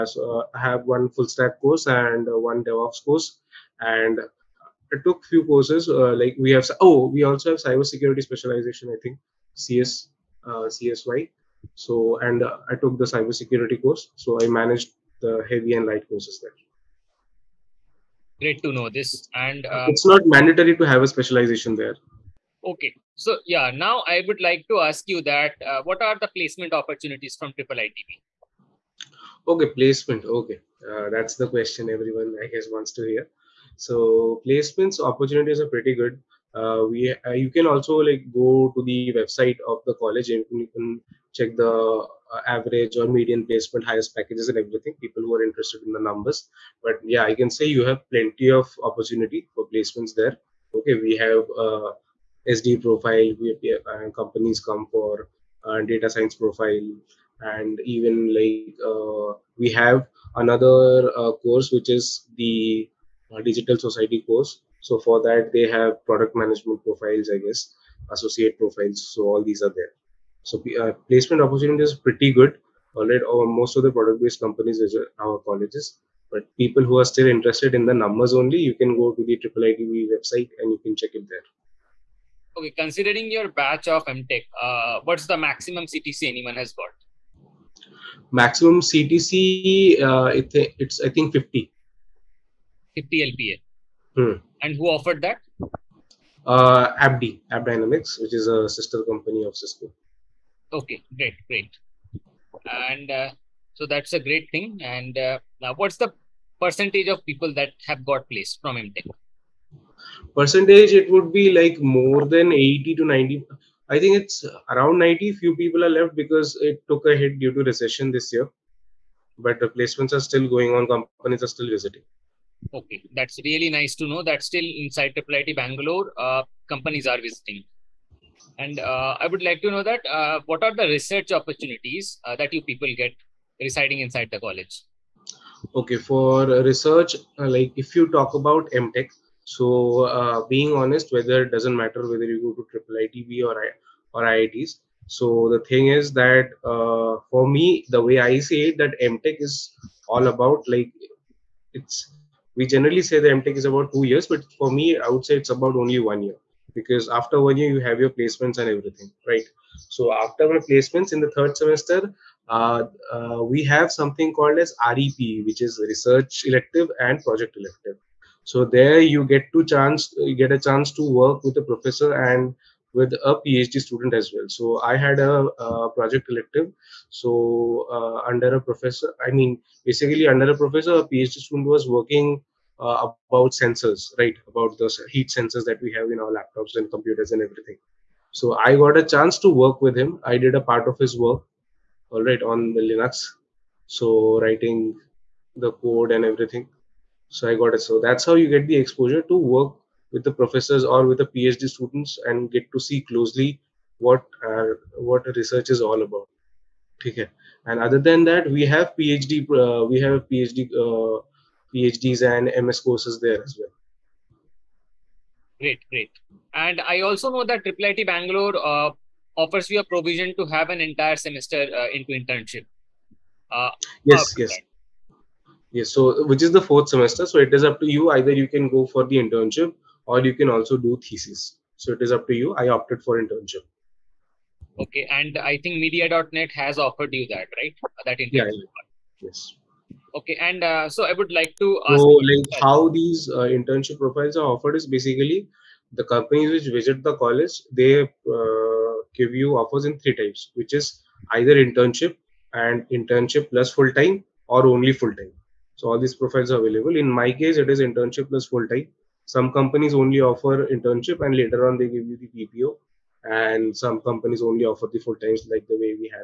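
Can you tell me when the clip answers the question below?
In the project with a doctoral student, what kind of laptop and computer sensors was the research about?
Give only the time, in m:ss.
3:05.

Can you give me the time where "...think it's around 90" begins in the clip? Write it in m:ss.
1:53.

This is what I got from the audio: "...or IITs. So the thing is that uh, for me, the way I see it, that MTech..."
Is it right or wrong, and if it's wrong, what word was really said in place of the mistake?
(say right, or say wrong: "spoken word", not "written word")
right.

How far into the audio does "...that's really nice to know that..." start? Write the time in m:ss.
2:03.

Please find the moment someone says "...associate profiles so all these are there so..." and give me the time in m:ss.
1:08.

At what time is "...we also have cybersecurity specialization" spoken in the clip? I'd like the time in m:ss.
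0:07.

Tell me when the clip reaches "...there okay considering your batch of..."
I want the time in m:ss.
1:21.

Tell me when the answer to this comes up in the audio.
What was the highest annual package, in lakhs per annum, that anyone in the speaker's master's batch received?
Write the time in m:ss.
1:32.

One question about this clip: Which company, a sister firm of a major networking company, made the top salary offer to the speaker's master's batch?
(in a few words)
AppD.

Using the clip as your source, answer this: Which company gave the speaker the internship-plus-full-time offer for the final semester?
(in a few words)
media.net.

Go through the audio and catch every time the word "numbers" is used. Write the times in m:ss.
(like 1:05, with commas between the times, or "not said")
0:46, 1:17.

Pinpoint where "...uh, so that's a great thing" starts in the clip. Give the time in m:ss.
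1:43.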